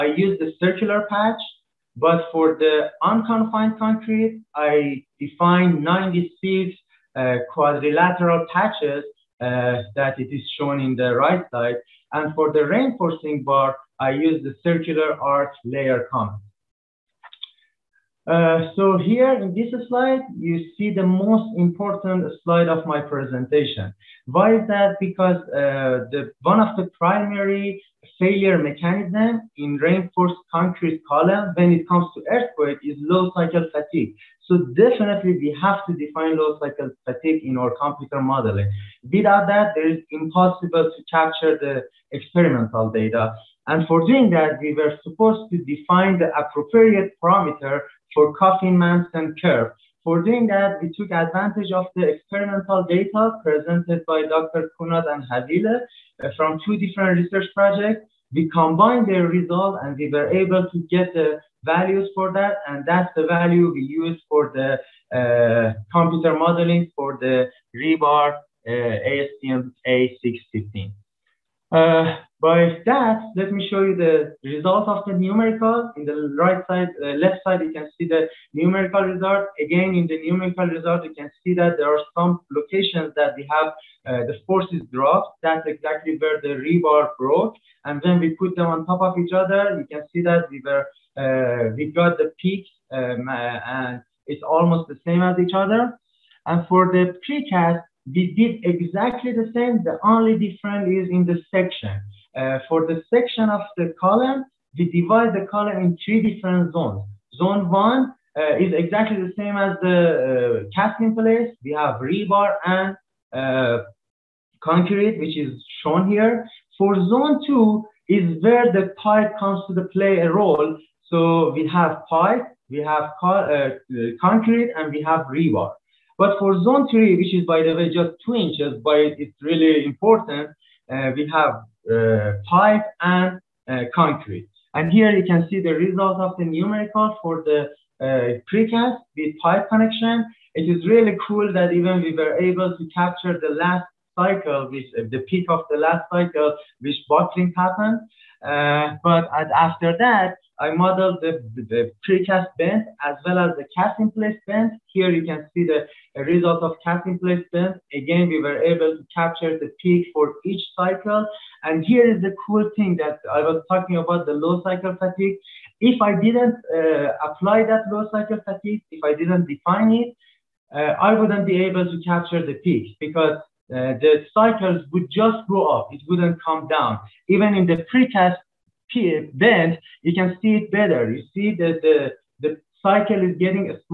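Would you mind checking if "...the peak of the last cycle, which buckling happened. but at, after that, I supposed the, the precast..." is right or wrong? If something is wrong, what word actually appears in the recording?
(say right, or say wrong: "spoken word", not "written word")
wrong: "modeled", not "supposed".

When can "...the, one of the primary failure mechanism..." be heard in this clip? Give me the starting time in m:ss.
0:26.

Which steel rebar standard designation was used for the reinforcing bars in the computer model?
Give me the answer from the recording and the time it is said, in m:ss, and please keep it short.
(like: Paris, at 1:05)
ASTM A615, at 1:08.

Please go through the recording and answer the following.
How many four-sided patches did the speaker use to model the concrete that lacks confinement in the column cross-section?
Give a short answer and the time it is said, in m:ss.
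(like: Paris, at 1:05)
96, at 0:05.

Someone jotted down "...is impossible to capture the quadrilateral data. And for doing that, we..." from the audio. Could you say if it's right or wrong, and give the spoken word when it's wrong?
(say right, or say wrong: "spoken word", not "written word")
wrong: "experimental", not "quadrilateral".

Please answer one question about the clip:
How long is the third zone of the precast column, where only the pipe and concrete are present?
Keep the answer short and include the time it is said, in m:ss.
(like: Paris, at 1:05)
2 inches, at 2:08.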